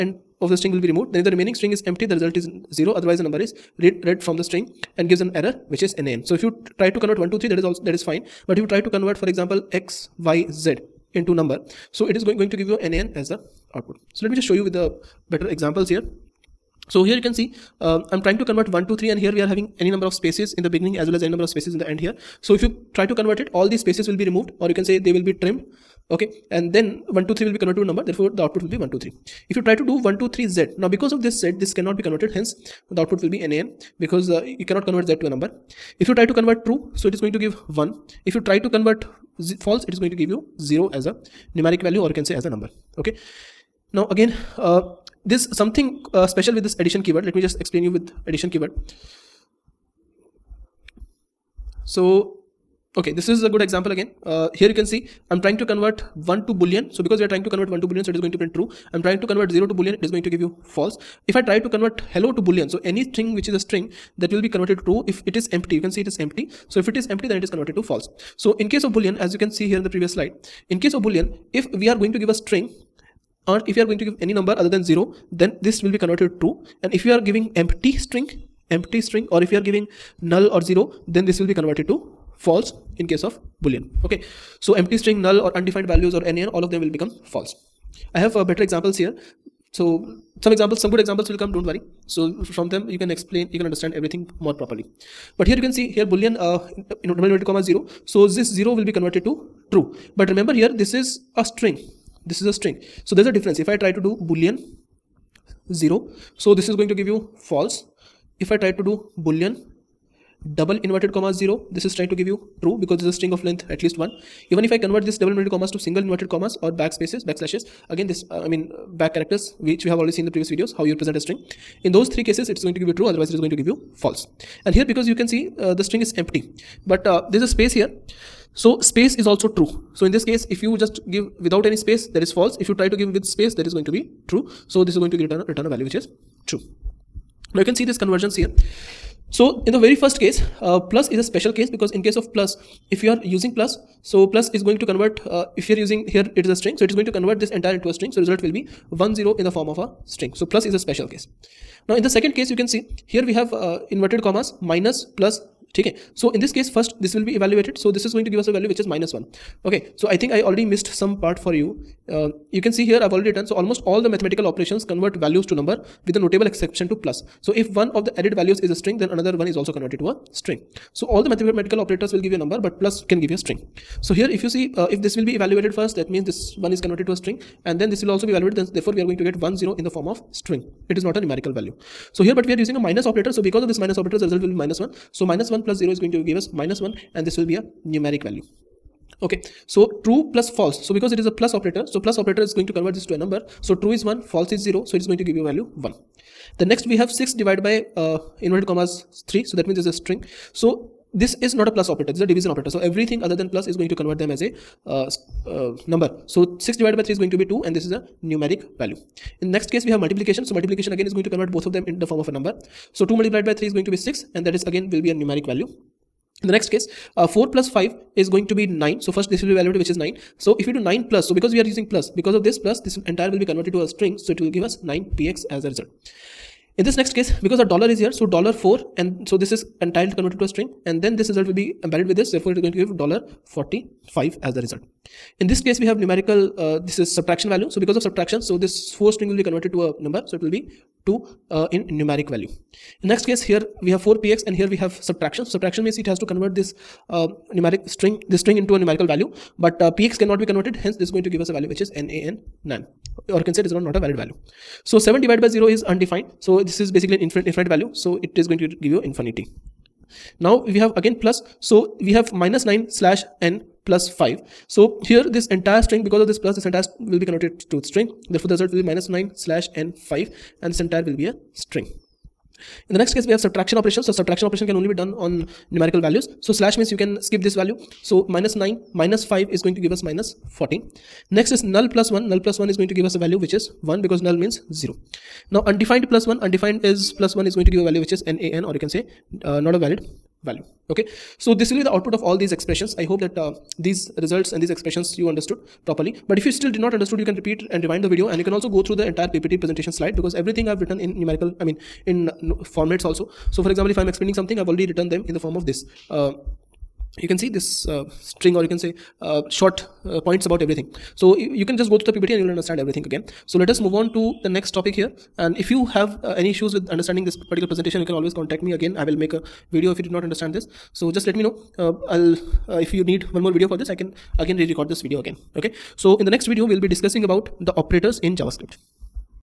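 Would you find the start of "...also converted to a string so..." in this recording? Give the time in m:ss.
2:49.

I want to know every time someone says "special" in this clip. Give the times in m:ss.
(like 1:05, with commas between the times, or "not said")
0:46, 2:21, 2:30.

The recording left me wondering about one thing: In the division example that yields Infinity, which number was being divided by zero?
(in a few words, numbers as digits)
7.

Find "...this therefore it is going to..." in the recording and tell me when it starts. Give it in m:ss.
3:52.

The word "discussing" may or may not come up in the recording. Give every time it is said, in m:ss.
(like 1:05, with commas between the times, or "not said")
5:26.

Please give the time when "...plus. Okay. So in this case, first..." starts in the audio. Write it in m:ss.
2:35.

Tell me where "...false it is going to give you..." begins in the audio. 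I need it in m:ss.
0:39.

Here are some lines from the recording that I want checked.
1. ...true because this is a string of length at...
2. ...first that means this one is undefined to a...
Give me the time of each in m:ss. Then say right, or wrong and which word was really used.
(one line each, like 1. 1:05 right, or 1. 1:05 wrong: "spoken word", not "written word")
1. 1:52 right
2. 2:55 wrong: "converted", not "undefined".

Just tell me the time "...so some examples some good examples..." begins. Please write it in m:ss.
1:29.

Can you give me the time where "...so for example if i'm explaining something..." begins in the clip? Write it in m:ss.
5:03.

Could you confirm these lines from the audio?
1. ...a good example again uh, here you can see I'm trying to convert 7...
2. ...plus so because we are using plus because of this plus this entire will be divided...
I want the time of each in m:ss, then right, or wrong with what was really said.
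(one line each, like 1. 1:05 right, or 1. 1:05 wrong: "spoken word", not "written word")
1. 0:53 wrong: "1", not "7"
2. 3:41 wrong: "converted", not "divided".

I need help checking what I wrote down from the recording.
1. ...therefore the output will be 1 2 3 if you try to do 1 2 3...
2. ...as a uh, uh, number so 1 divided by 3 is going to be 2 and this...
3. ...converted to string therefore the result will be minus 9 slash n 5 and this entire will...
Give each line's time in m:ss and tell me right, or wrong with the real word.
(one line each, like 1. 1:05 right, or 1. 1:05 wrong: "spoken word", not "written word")
1. 0:28 right
2. 3:24 wrong: "6", not "1"
3. 4:27 right.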